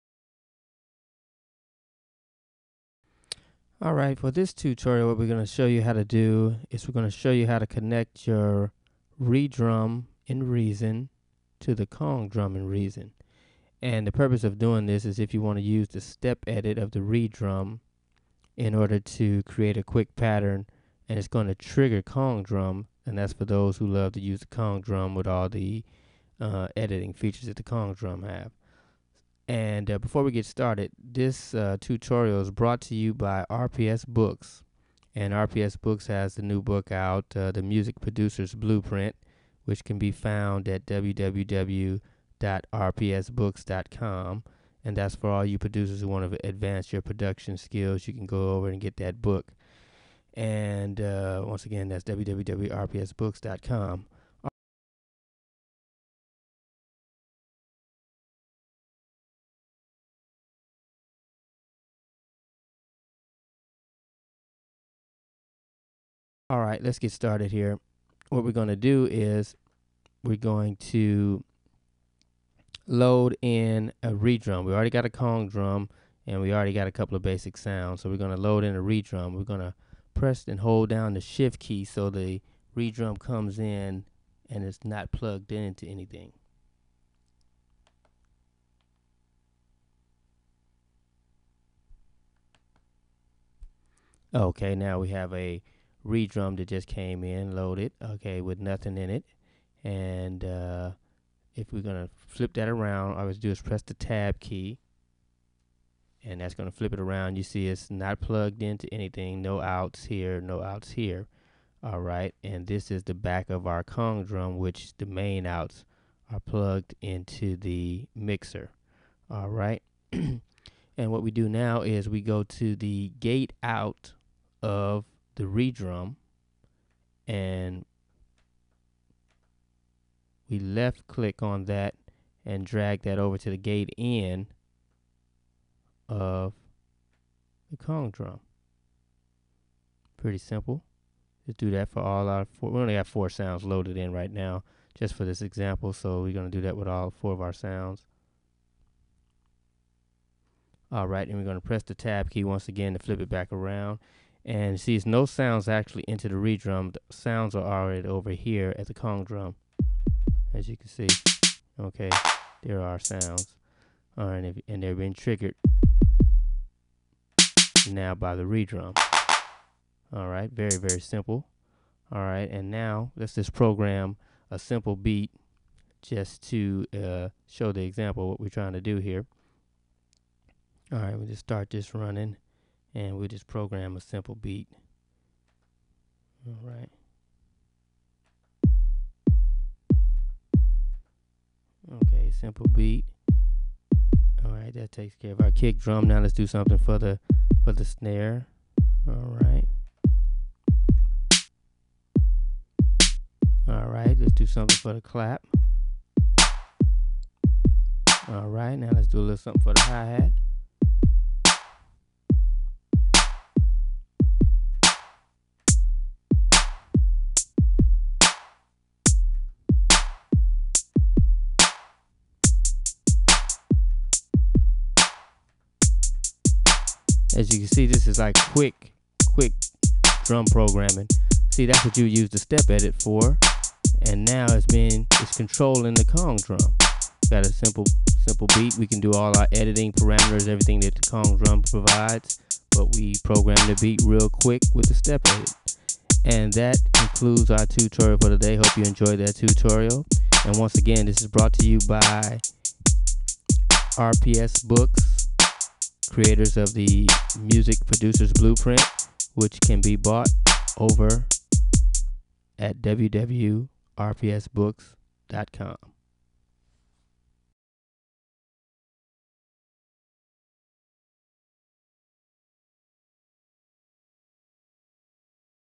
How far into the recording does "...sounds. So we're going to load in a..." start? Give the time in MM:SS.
01:17.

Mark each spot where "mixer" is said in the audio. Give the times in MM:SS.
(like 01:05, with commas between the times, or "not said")
01:58.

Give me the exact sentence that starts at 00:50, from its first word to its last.
And uh, once again, that's www.rpsbooks.com.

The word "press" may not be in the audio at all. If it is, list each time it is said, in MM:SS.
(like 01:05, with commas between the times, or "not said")
01:20, 01:43, 02:31.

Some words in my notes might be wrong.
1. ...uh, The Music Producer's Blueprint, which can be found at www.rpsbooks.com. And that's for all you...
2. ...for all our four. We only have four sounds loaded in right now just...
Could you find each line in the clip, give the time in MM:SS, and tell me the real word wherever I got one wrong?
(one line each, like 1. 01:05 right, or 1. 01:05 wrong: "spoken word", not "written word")
1. 00:37 right
2. 02:21 right.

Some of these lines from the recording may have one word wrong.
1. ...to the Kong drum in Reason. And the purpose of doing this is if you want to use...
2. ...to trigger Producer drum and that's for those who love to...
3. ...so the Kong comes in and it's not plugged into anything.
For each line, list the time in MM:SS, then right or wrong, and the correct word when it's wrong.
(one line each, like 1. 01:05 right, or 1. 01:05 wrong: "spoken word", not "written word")
1. 00:11 right
2. 00:21 wrong: "Kong", not "Producer"
3. 01:21 wrong: "Redrum", not "Kong".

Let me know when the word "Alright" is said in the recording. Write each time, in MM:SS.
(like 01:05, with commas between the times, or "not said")
00:03.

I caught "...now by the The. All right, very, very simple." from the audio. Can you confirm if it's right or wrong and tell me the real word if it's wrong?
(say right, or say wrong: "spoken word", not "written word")
wrong: "Redrum", not "The".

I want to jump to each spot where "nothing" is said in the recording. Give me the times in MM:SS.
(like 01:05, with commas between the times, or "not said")
01:38.